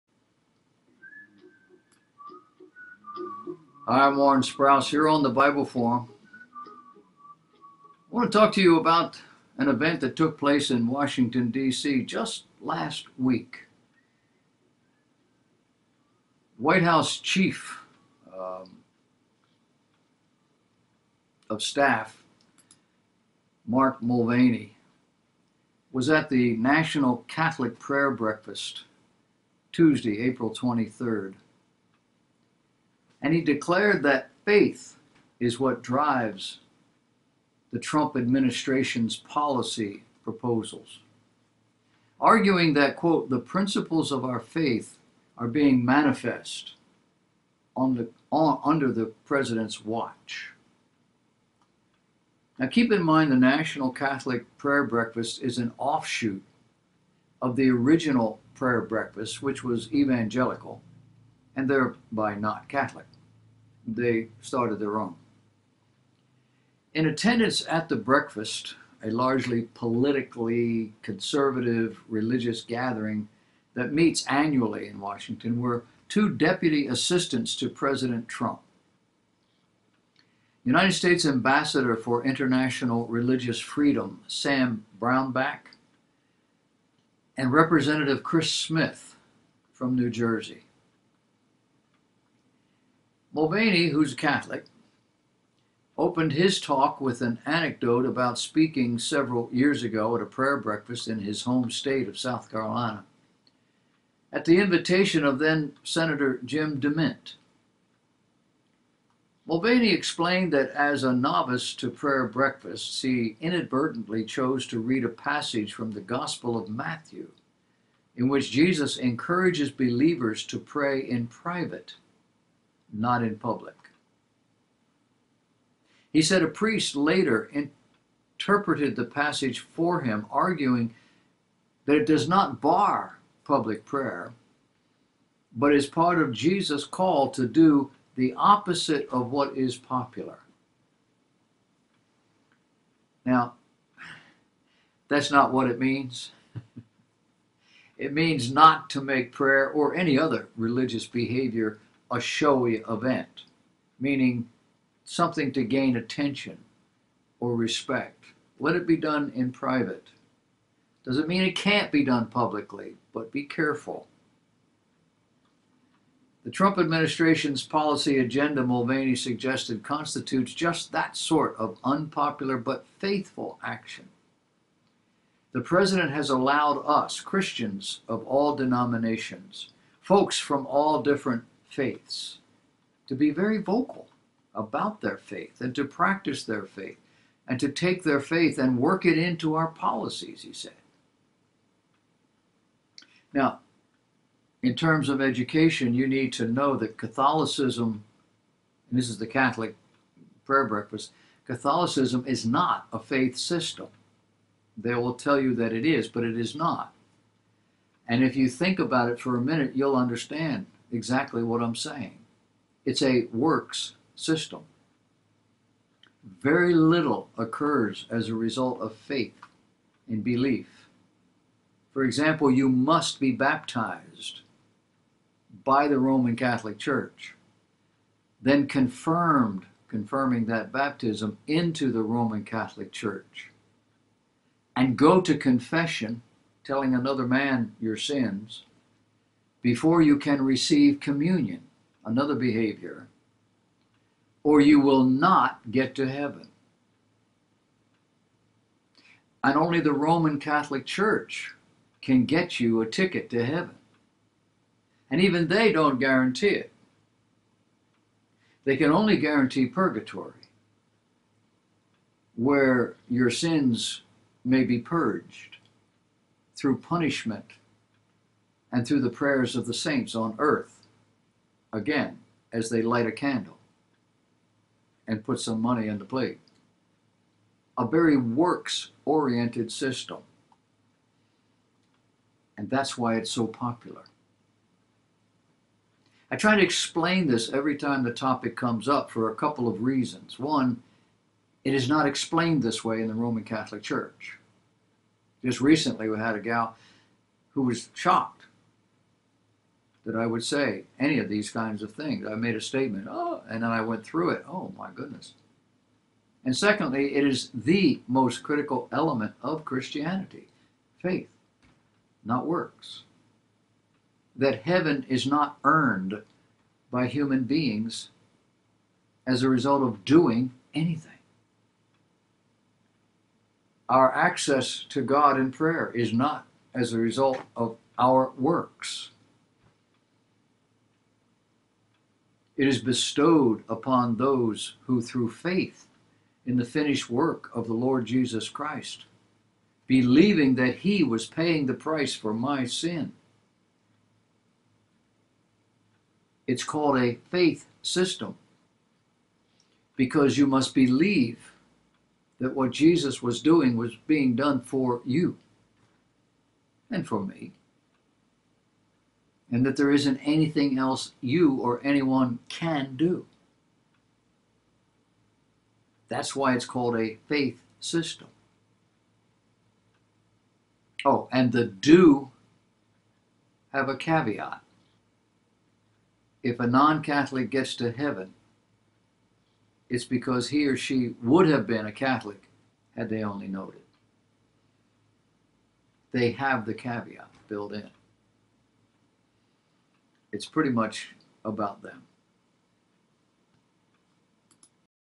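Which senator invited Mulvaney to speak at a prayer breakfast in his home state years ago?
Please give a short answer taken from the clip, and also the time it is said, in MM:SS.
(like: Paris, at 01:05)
Jim DeMint, at 01:46.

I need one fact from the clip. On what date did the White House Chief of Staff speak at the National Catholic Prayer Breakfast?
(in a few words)
April 23rd.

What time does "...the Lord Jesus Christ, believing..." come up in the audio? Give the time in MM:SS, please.
05:37.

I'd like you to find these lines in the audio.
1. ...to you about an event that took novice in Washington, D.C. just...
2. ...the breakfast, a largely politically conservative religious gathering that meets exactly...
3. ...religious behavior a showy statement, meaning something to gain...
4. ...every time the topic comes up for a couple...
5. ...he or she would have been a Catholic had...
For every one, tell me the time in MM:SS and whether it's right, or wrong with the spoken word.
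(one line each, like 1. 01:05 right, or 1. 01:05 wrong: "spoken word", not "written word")
1. 00:08 wrong: "place", not "novice"
2. 01:07 wrong: "annually", not "exactly"
3. 02:30 wrong: "event", not "statement"
4. 04:47 right
5. 06:20 right.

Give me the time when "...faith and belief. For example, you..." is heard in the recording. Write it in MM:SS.
03:38.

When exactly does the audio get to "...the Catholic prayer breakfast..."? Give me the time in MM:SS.
03:19.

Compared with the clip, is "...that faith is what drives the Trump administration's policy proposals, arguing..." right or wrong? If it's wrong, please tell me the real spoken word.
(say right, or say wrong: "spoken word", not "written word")
right.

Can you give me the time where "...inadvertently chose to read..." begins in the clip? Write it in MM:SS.
01:53.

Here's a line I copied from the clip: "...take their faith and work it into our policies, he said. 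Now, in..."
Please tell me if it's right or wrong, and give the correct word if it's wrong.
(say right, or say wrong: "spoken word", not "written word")
right.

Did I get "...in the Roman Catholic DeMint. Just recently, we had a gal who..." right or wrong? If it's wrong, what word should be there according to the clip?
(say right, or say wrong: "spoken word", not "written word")
wrong: "Church", not "DeMint".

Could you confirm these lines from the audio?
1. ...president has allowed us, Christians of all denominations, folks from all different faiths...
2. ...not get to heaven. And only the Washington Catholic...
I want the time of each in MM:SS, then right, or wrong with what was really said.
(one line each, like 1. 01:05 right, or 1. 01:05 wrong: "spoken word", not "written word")
1. 02:55 right
2. 04:05 wrong: "Roman", not "Washington".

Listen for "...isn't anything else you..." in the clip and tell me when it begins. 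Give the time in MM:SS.
05:59.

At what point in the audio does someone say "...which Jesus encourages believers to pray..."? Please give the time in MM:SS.
01:58.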